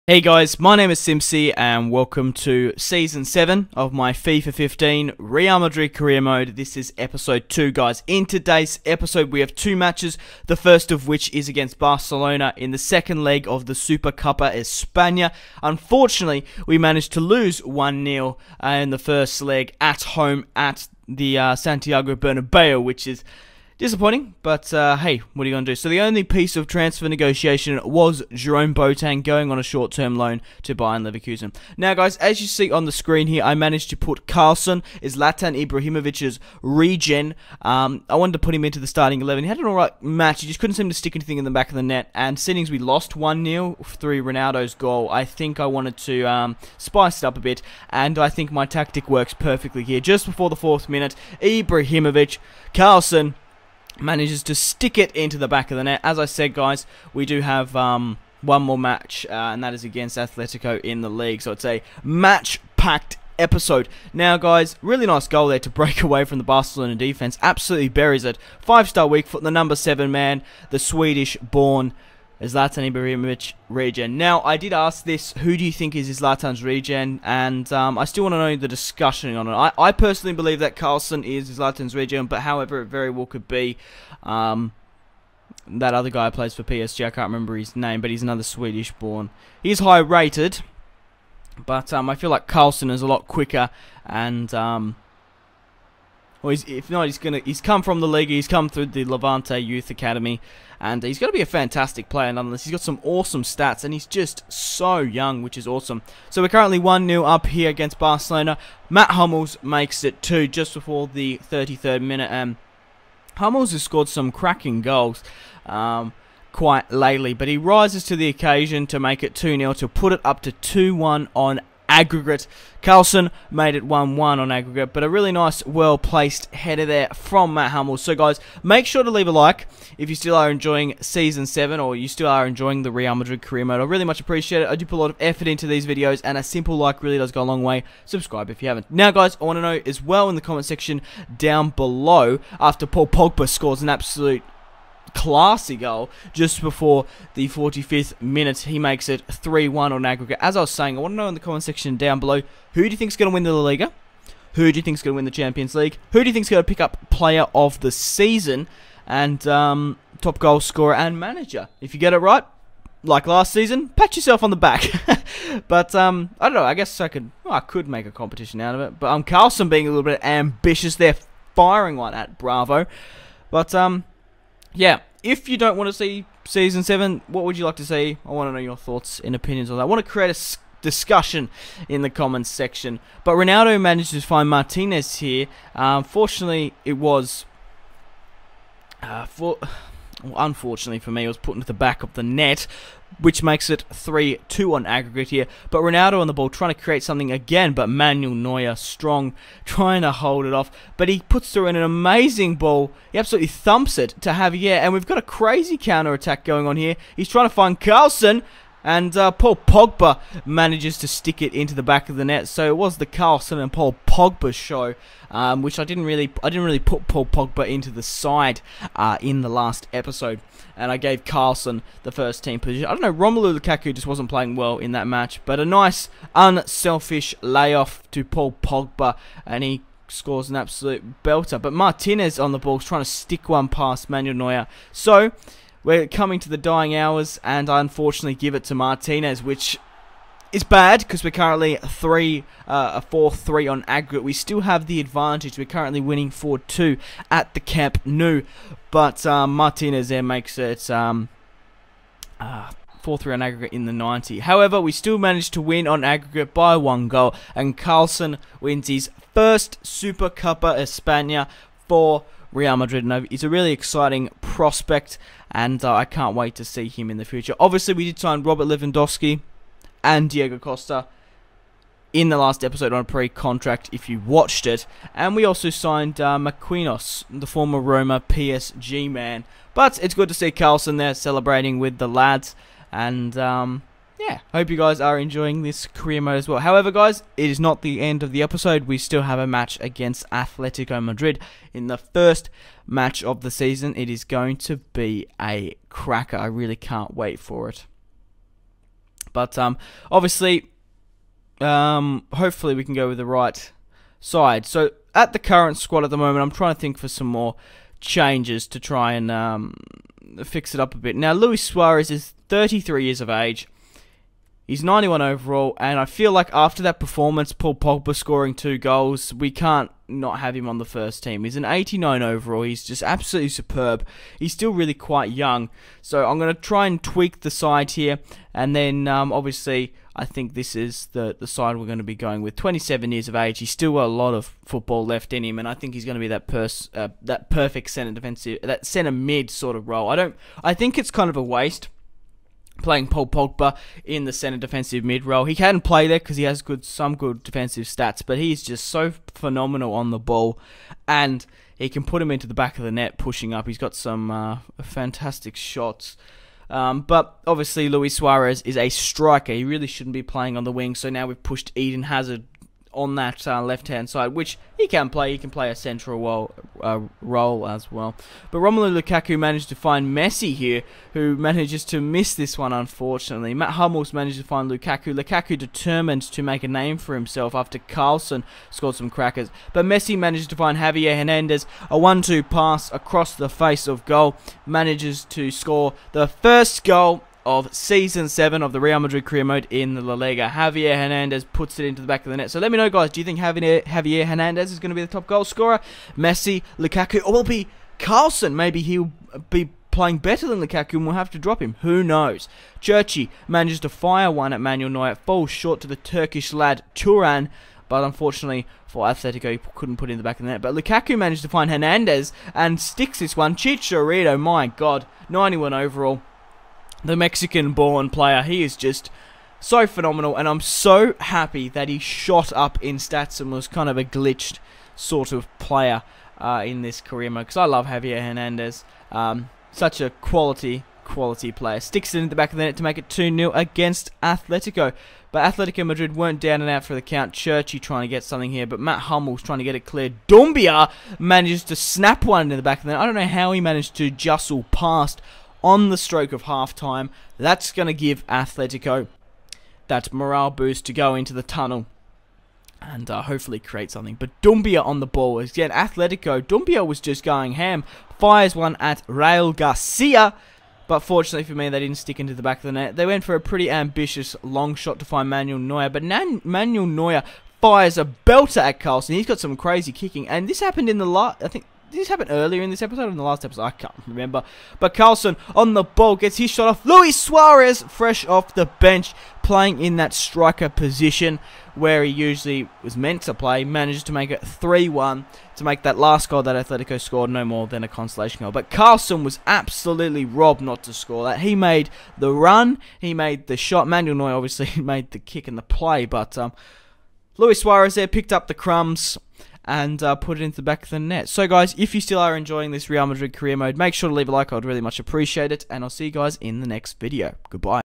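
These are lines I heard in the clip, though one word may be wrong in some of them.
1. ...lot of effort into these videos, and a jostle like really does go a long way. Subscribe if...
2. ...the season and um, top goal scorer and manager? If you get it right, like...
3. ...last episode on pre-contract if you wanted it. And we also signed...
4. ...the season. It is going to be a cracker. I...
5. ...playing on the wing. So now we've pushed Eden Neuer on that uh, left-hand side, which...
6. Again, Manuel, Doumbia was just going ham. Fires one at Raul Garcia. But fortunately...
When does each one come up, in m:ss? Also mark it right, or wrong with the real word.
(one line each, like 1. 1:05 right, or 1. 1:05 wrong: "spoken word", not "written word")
1. 2:15 wrong: "simple", not "jostle"
2. 2:37 right
3. 4:32 wrong: "watched", not "wanted"
4. 4:53 right
5. 6:00 wrong: "Hazard", not "Neuer"
6. 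7:35 wrong: "Atletico", not "Manuel".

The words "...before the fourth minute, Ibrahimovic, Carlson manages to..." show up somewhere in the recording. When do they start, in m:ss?
0:50.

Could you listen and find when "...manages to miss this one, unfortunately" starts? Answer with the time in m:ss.
6:11.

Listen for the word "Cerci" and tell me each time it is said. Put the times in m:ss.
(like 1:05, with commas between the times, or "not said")
6:42, 7:17.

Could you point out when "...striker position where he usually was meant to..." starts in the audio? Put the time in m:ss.
8:00.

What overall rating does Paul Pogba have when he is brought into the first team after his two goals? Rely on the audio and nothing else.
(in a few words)
89.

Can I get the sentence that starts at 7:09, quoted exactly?
Um, such a quality, quality player.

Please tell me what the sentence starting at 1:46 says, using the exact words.
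So we're currently one 0 up here against Barcelona.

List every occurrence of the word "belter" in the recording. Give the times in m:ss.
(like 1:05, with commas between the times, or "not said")
3:51, 7:48.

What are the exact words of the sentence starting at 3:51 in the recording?
But Martinez on the ball, trying to stick one past Manuel Neuer.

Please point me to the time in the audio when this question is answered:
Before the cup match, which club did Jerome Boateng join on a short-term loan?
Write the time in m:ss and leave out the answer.
0:30.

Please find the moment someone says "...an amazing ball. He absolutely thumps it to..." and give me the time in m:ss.
3:21.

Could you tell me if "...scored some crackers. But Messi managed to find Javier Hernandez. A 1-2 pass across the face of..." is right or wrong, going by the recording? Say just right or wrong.
right.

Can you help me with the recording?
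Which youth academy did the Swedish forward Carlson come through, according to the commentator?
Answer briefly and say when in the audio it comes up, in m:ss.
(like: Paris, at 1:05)
Levante Youth Academy, at 1:39.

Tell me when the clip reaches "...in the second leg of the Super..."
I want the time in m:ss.
0:12.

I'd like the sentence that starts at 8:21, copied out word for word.
So, guys, if you still are enjoying this Real Madrid career mode, make sure to leave a like.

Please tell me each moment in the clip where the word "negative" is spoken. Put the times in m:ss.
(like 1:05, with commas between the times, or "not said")
not said.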